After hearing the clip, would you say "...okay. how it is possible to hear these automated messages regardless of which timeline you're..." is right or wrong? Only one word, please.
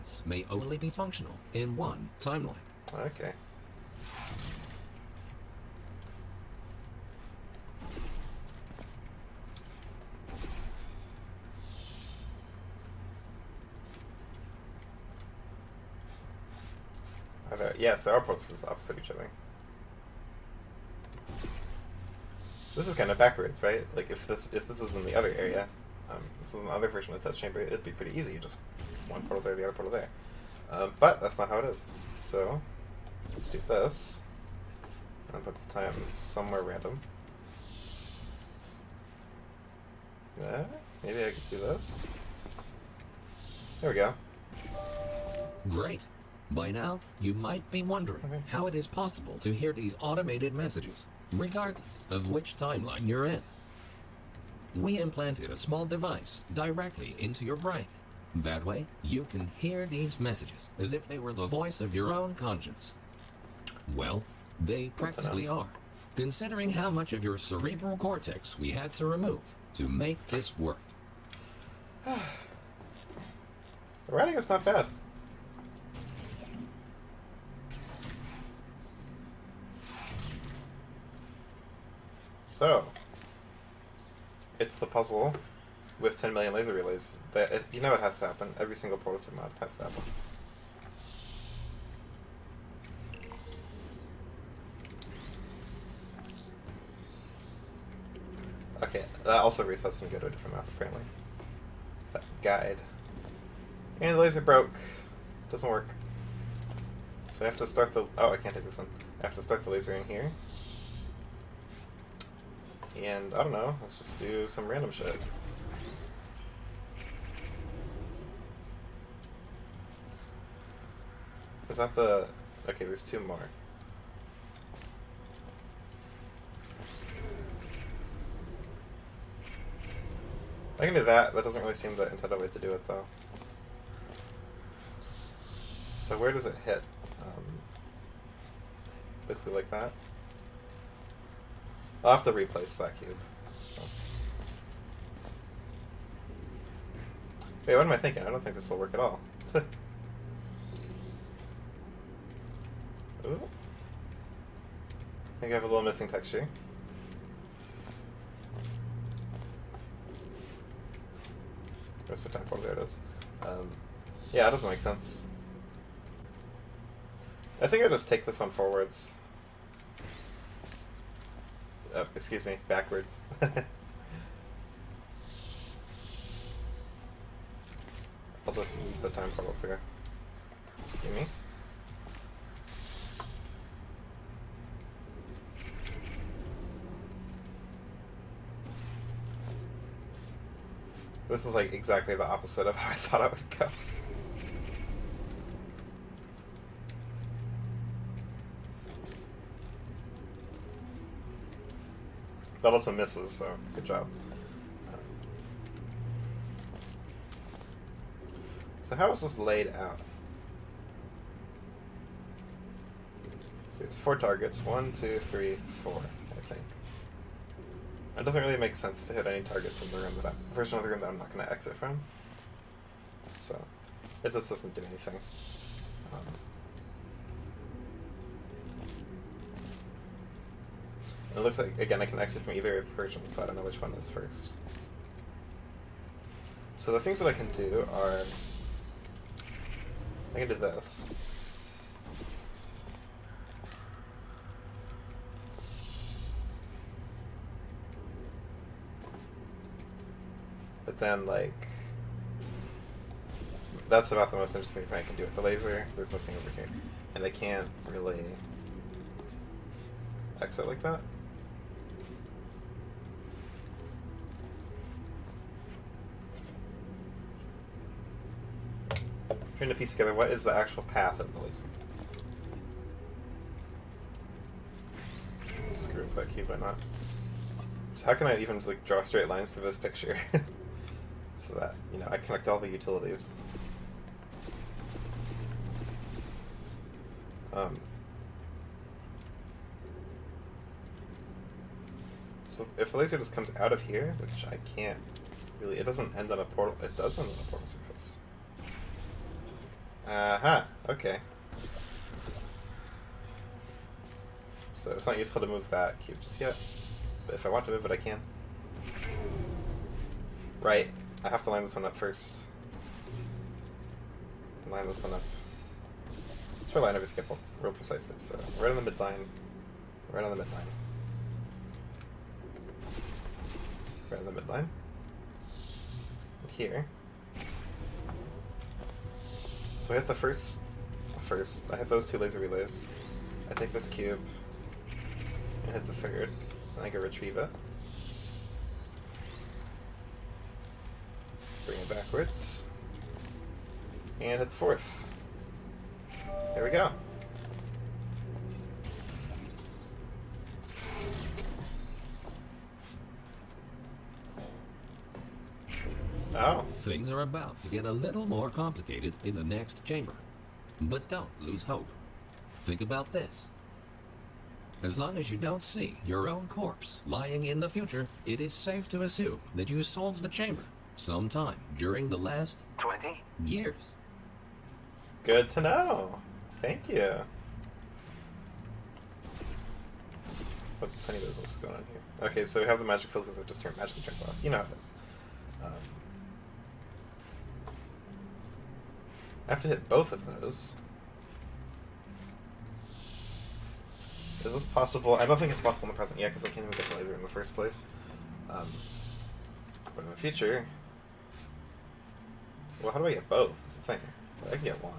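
right.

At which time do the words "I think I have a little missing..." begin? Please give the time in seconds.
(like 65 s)
155 s.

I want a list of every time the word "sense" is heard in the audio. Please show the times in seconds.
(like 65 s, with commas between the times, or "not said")
164 s, 218 s.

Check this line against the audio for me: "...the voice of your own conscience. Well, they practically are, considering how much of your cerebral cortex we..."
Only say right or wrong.
right.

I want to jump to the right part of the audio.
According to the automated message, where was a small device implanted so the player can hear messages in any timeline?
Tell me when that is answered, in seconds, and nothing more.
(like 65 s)
56 s.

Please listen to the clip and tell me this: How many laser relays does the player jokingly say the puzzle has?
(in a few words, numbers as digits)
10 million.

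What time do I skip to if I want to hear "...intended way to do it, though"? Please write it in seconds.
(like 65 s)
132 s.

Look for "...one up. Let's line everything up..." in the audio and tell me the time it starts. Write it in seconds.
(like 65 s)
315 s.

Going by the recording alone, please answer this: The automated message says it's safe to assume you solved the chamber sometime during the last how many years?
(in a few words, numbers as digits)
20.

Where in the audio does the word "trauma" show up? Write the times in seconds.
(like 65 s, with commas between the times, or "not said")
not said.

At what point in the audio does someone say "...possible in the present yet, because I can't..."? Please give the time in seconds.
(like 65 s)
395 s.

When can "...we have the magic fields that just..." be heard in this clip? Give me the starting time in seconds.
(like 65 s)
382 s.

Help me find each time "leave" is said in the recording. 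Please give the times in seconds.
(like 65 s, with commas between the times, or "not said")
178 s.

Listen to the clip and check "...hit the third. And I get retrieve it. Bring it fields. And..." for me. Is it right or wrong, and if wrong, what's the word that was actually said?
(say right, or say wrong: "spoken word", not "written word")
wrong: "backwards", not "fields".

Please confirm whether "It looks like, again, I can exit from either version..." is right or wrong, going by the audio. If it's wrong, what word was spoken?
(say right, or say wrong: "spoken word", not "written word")
right.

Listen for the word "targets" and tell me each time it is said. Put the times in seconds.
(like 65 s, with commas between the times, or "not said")
214 s, 219 s.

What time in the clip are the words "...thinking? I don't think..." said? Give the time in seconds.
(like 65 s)
147 s.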